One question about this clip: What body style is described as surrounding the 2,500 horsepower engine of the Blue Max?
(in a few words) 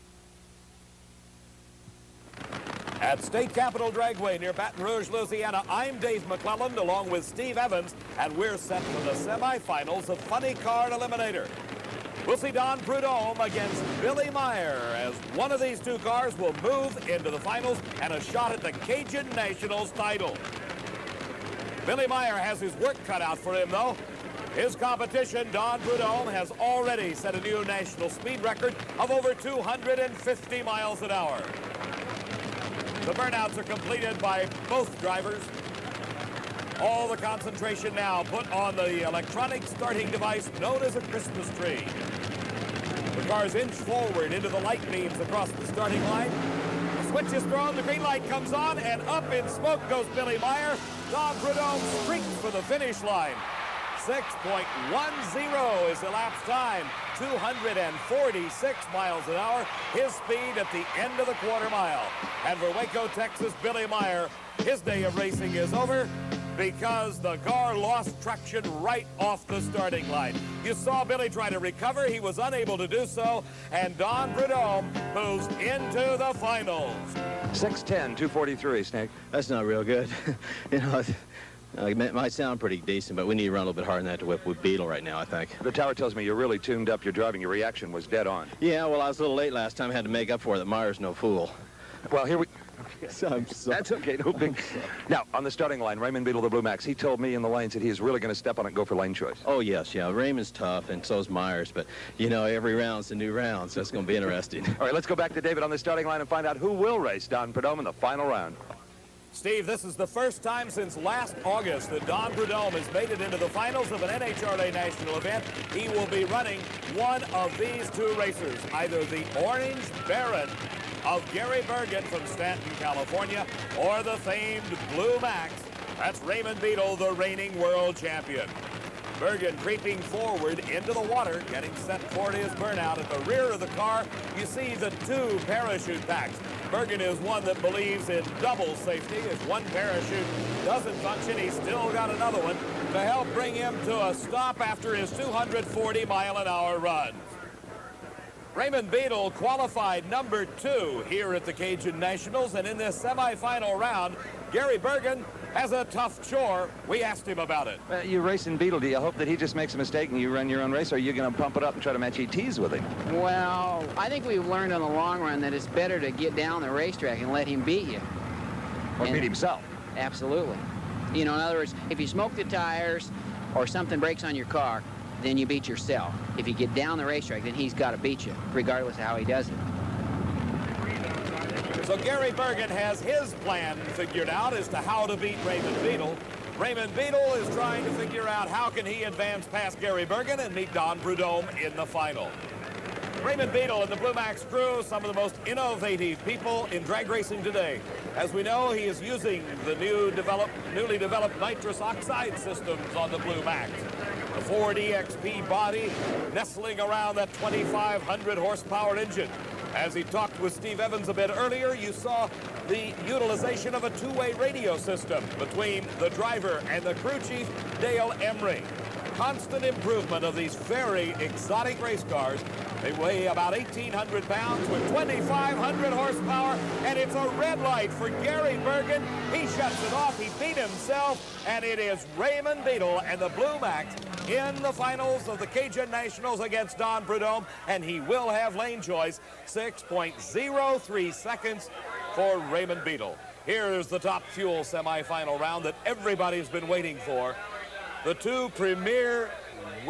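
Ford EXP.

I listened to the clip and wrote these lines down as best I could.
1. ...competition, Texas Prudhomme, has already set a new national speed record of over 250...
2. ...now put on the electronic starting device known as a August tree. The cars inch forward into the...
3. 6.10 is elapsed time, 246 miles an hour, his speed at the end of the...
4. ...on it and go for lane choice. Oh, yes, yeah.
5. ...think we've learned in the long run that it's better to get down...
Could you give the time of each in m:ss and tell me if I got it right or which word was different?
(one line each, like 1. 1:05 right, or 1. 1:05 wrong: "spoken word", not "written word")
1. 0:24 wrong: "Don", not "Texas"
2. 0:37 wrong: "Christmas", not "August"
3. 0:54 right
4. 1:38 right
5. 2:44 right.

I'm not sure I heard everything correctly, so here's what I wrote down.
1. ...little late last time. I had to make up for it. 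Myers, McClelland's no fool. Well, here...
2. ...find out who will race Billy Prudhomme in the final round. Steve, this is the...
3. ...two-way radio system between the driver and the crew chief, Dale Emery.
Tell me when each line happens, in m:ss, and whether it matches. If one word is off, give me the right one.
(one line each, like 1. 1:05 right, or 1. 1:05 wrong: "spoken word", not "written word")
1. 1:29 wrong: "Meyer", not "McClelland"
2. 1:46 wrong: "Don", not "Billy"
3. 3:33 right.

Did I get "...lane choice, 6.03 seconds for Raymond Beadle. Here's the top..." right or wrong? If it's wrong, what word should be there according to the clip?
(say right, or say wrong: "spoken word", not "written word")
right.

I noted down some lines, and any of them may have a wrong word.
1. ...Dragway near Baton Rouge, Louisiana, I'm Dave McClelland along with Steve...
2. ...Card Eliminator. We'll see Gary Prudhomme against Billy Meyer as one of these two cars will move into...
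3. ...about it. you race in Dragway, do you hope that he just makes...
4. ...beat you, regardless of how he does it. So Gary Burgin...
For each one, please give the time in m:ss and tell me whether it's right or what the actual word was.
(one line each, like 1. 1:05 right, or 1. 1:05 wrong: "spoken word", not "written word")
1. 0:03 right
2. 0:10 wrong: "Don", not "Gary"
3. 2:37 wrong: "Beadle", not "Dragway"
4. 2:57 right.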